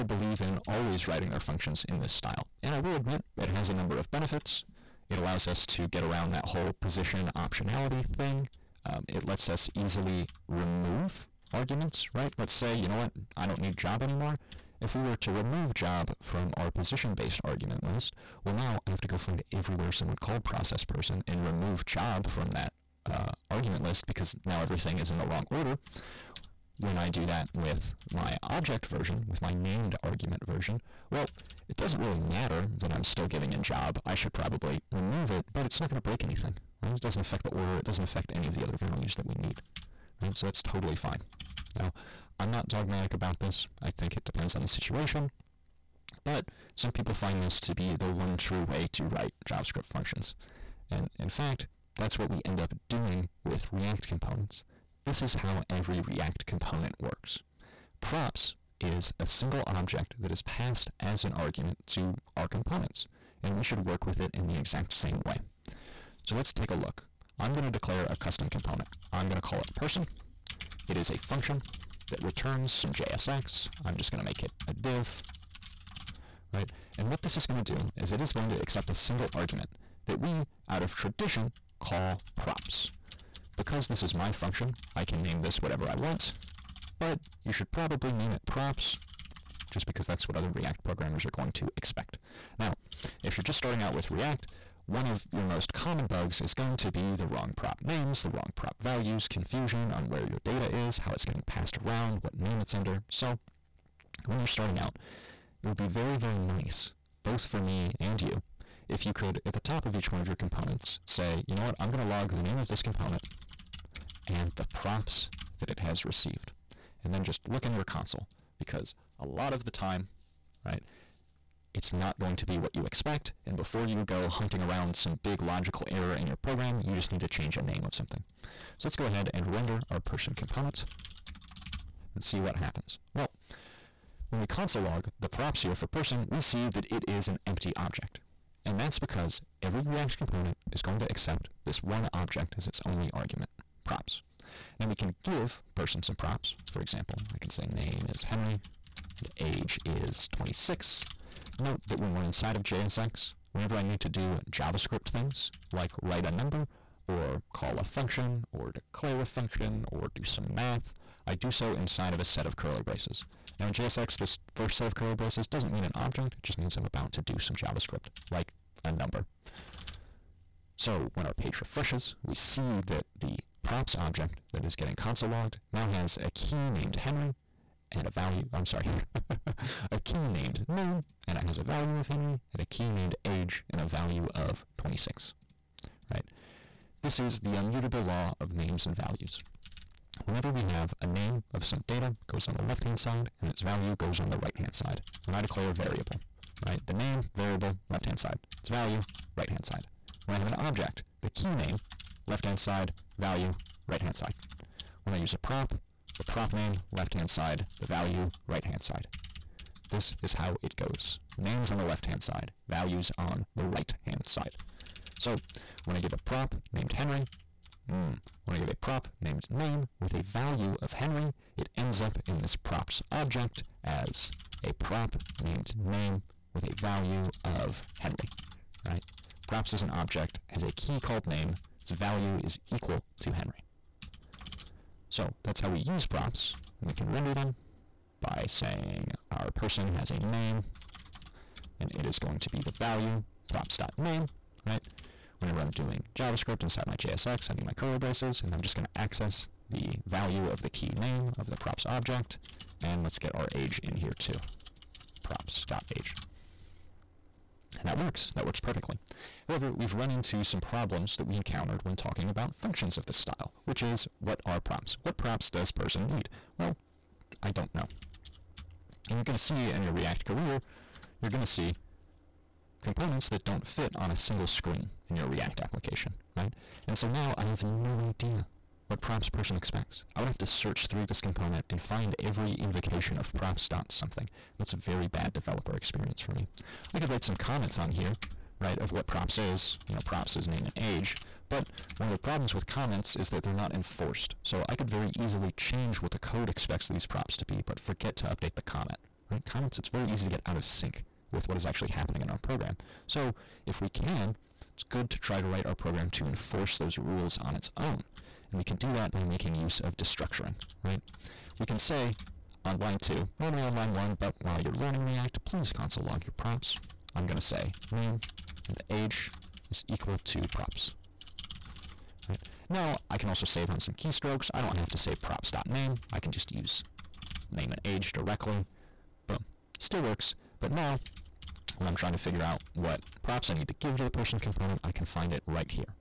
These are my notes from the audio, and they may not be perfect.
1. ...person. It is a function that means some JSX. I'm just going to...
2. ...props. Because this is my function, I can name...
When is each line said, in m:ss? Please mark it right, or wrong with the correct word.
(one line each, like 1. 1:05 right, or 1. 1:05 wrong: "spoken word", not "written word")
1. 1:09 wrong: "returns", not "means"
2. 1:22 right.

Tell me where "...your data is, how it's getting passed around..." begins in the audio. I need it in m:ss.
1:40.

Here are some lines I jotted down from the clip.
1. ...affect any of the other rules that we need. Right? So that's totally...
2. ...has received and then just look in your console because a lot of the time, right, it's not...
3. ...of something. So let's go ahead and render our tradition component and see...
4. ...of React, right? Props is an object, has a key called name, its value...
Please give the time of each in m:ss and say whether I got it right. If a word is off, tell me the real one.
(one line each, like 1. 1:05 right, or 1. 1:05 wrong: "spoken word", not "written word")
1. 0:38 wrong: "values", not "rules"
2. 1:55 right
3. 2:07 wrong: "person", not "tradition"
4. 3:47 wrong: "Henry", not "React".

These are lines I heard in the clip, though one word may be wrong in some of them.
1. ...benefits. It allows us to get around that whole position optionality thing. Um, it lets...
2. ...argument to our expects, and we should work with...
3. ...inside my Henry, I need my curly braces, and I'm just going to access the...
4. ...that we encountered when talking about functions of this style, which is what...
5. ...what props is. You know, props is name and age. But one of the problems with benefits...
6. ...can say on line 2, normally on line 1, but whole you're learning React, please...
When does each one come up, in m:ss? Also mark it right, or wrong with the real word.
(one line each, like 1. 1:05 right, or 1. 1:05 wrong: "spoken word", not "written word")
1. 0:04 right
2. 1:01 wrong: "components", not "expects"
3. 4:06 wrong: "JSX", not "Henry"
4. 4:21 right
5. 4:48 wrong: "comments", not "benefits"
6. 5:11 wrong: "while", not "whole".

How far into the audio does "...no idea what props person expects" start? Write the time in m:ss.
4:37.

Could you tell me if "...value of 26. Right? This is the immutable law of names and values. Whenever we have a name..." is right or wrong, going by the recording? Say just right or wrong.
right.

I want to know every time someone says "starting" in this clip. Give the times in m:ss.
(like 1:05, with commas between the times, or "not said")
1:33, 1:44.